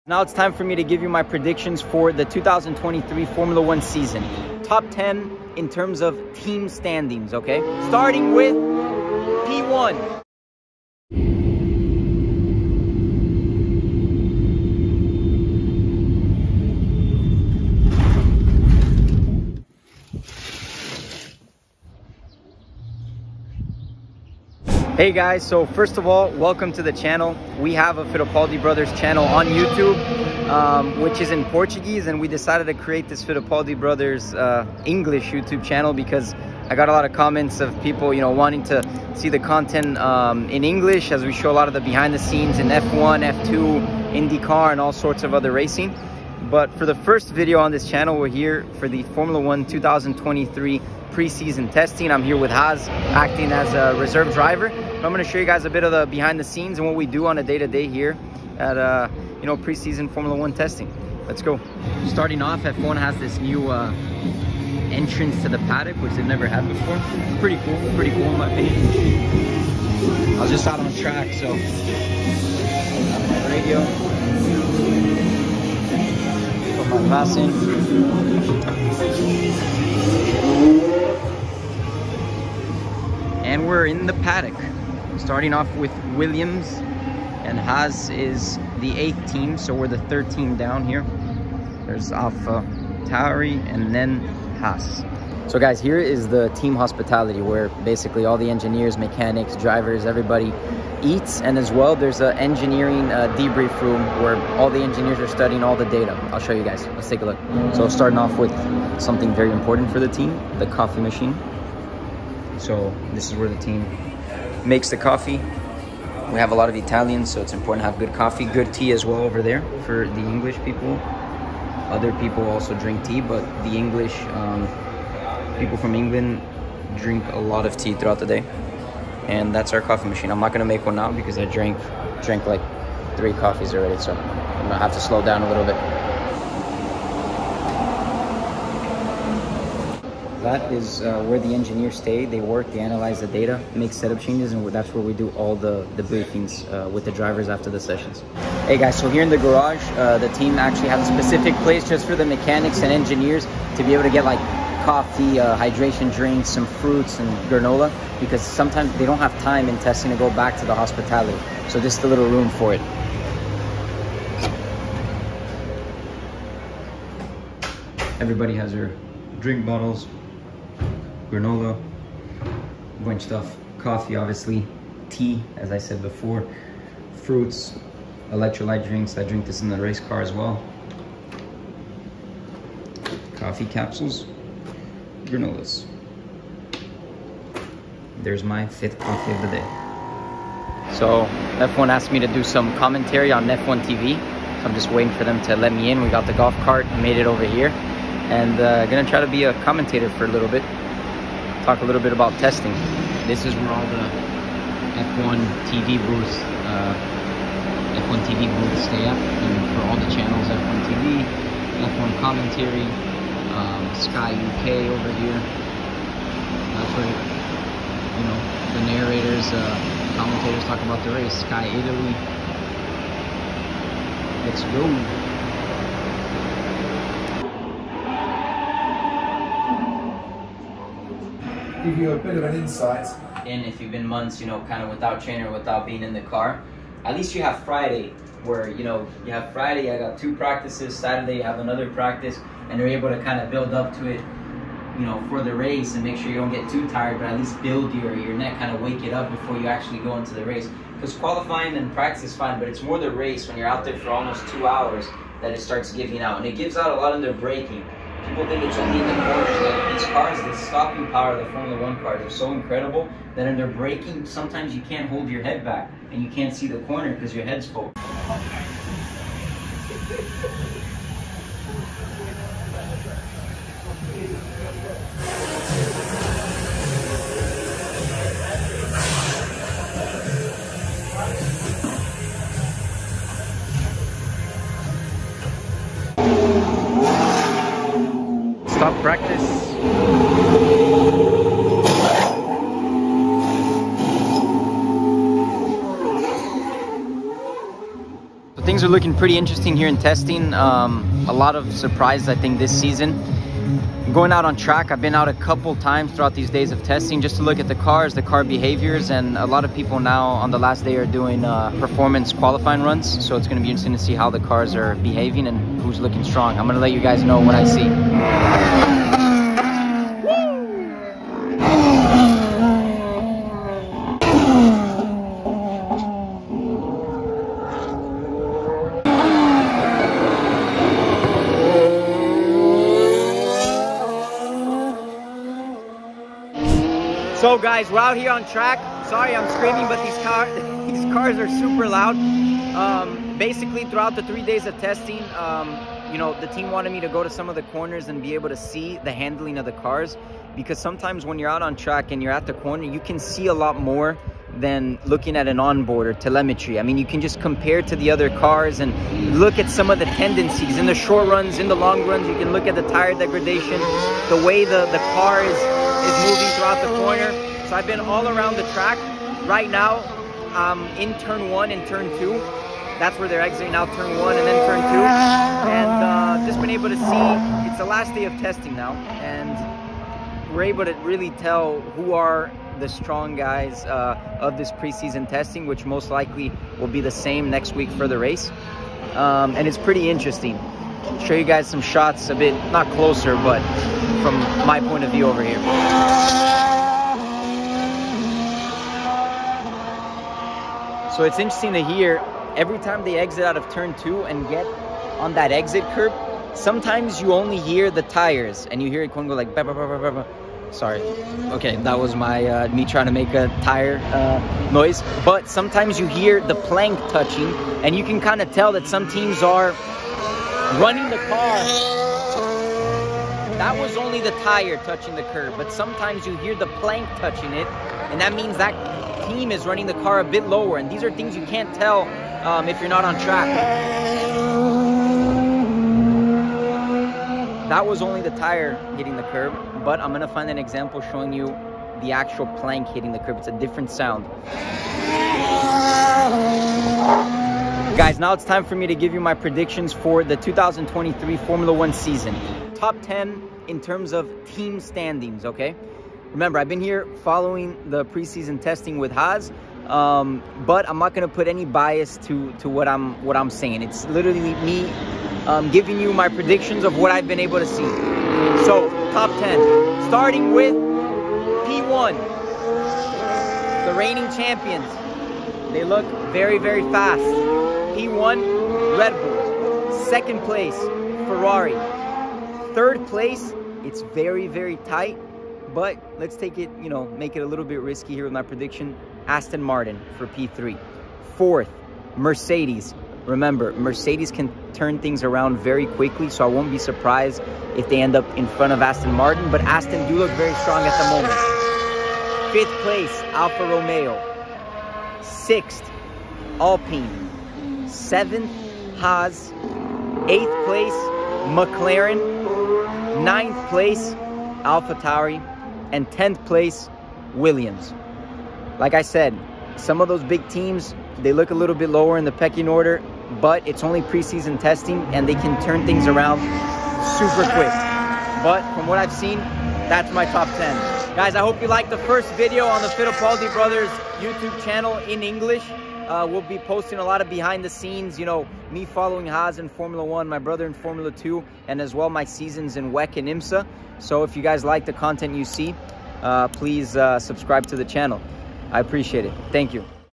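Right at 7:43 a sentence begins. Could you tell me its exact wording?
It's literally me um, giving you my predictions of what I've been able to see.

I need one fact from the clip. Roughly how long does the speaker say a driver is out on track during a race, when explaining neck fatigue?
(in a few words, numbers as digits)
Almost two hours.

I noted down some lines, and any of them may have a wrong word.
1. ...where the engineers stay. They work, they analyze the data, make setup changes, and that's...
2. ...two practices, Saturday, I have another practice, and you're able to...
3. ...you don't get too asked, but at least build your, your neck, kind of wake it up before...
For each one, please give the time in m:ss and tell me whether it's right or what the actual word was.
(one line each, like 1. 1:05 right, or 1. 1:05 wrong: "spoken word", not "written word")
1. 2:21 right
2. 4:00 right
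3. 4:06 wrong: "tired", not "asked".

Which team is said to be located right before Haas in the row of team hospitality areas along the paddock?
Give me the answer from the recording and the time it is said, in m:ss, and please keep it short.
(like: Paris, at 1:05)
Alpha Tauri, at 1:31.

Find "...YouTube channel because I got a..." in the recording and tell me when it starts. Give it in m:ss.
0:35.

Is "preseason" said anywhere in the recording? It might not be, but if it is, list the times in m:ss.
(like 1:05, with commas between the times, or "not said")
0:51, 0:59, 6:24, 7:38, 8:44.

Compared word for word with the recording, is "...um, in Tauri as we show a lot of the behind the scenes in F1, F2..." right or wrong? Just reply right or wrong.
wrong.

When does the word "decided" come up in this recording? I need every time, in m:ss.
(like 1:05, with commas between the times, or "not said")
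0:32.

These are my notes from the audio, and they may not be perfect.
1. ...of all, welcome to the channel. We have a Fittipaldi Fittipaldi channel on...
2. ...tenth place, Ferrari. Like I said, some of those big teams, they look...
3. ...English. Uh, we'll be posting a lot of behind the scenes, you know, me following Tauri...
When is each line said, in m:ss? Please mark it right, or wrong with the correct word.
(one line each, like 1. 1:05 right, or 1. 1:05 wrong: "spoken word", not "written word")
1. 0:25 wrong: "Brothers", not "Fittipaldi"
2. 8:36 wrong: "Williams", not "Ferrari"
3. 8:55 wrong: "Haas", not "Tauri".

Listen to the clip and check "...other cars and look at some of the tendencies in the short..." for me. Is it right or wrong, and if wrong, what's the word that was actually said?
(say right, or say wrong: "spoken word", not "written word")
right.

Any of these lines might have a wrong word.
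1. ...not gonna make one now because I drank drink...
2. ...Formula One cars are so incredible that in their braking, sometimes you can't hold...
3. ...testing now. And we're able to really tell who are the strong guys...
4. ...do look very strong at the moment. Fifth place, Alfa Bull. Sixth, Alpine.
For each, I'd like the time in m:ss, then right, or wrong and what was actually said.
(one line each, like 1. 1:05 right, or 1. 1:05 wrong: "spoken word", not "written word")
1. 2:10 right
2. 4:21 right
3. 6:18 right
4. 8:20 wrong: "Romeo", not "Bull".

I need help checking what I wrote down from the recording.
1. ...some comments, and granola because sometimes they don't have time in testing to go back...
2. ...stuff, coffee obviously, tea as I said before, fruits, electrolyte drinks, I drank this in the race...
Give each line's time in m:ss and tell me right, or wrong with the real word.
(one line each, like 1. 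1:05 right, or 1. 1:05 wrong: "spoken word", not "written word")
1. 2:36 wrong: "fruits", not "comments"
2. 2:53 wrong: "drink", not "drank".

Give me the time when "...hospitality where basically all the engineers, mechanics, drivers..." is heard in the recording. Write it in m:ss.
1:36.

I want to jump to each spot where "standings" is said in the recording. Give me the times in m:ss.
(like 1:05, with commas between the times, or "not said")
0:06, 7:34.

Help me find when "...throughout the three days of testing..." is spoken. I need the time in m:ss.
5:43.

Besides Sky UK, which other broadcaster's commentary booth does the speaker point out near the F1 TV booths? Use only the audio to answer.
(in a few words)
Sky Italy.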